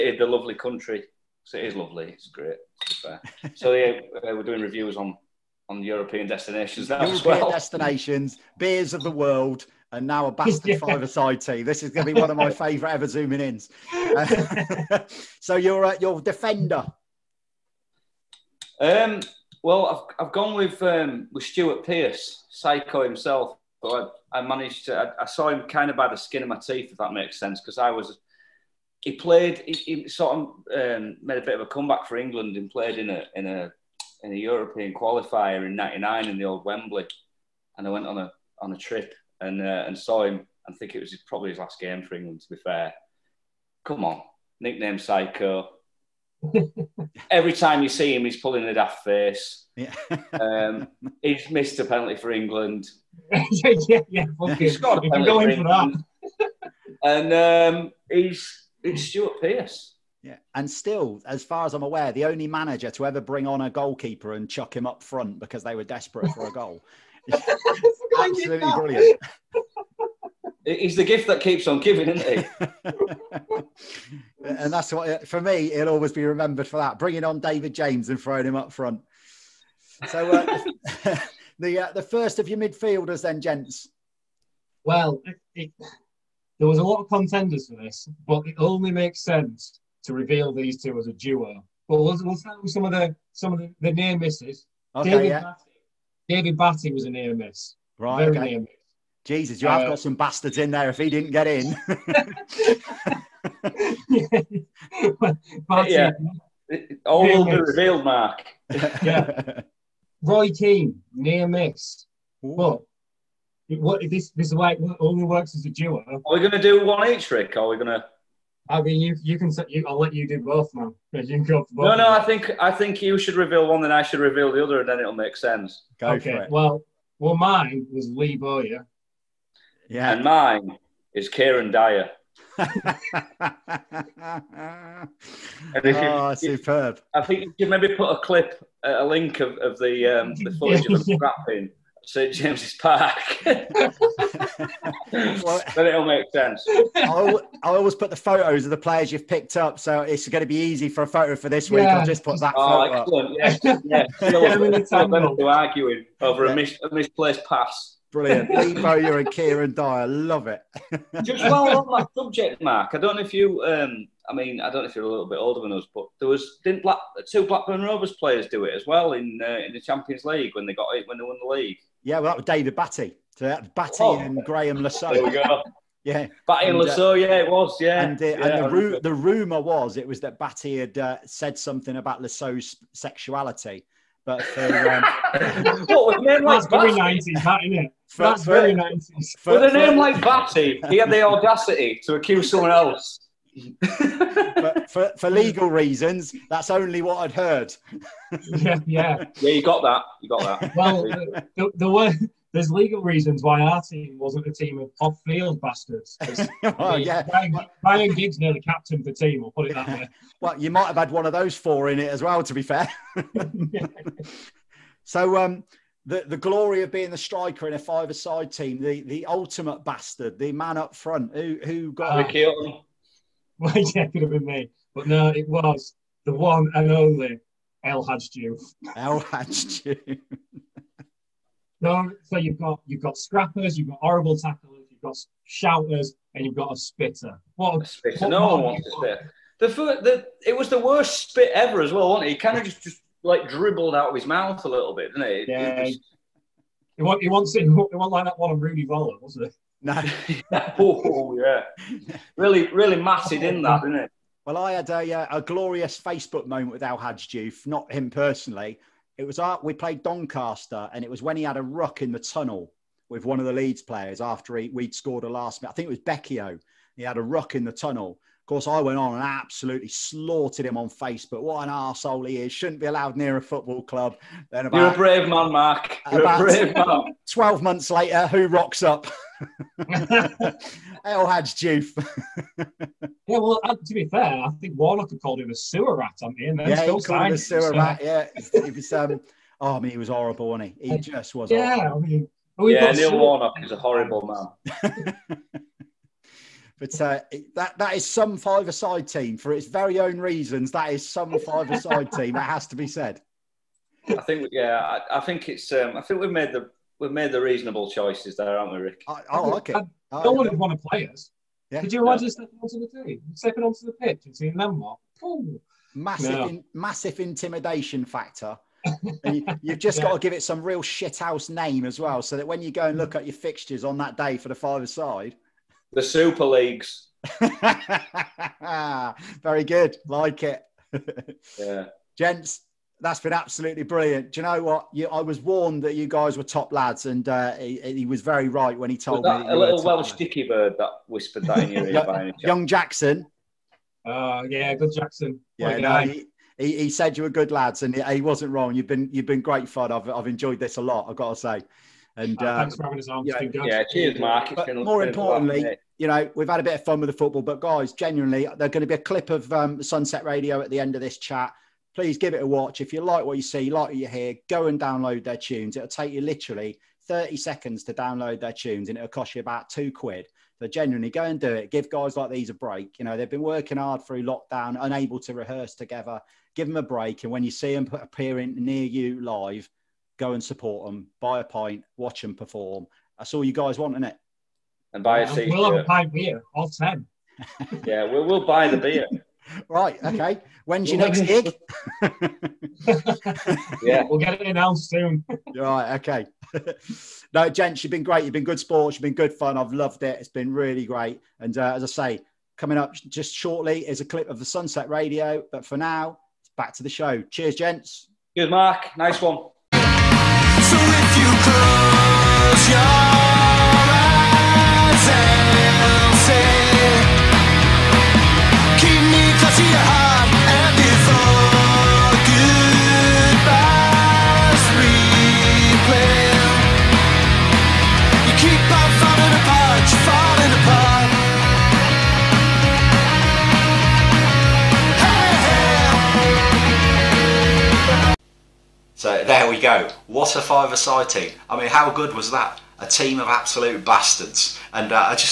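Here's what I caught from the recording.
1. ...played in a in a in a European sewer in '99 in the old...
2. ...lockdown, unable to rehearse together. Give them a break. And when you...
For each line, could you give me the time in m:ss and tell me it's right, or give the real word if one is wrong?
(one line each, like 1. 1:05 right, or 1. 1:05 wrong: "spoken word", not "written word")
1. 0:32 wrong: "qualifier", not "sewer"
2. 6:14 right.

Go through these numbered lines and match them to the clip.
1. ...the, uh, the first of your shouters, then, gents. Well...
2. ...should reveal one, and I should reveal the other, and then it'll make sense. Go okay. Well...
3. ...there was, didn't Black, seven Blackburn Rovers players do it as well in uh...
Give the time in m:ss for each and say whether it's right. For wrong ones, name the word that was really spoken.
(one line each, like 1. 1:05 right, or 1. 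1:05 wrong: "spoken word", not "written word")
1. 1:21 wrong: "midfielders", not "shouters"
2. 2:03 right
3. 2:46 wrong: "two", not "seven".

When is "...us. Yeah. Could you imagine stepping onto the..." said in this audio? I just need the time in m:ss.
5:11.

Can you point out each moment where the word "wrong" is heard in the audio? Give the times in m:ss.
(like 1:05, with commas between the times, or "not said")
5:48.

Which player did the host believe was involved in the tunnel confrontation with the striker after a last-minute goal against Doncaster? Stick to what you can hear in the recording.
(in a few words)
Becchio.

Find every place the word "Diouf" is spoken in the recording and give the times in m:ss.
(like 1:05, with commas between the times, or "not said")
3:51, 4:17, 4:41.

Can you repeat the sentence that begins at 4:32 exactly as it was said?
Shouldn't be allowed near a football club.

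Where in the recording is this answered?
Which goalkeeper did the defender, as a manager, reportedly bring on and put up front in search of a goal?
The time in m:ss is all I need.
1:17.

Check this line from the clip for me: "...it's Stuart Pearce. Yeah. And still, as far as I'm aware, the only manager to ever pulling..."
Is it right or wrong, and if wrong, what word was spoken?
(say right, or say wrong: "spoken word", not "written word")
wrong: "bring", not "pulling".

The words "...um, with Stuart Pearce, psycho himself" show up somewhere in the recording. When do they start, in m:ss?
0:20.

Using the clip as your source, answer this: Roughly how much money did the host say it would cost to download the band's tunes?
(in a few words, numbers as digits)
about two quid.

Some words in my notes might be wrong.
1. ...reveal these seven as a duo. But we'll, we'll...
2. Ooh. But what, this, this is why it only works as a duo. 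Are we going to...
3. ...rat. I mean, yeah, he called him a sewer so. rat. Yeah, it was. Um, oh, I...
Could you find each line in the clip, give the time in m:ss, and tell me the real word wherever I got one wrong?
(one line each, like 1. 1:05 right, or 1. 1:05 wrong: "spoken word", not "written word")
1. 1:30 wrong: "two", not "seven"
2. 1:52 right
3. 4:45 right.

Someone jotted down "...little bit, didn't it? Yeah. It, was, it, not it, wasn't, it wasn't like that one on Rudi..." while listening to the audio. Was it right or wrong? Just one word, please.
right.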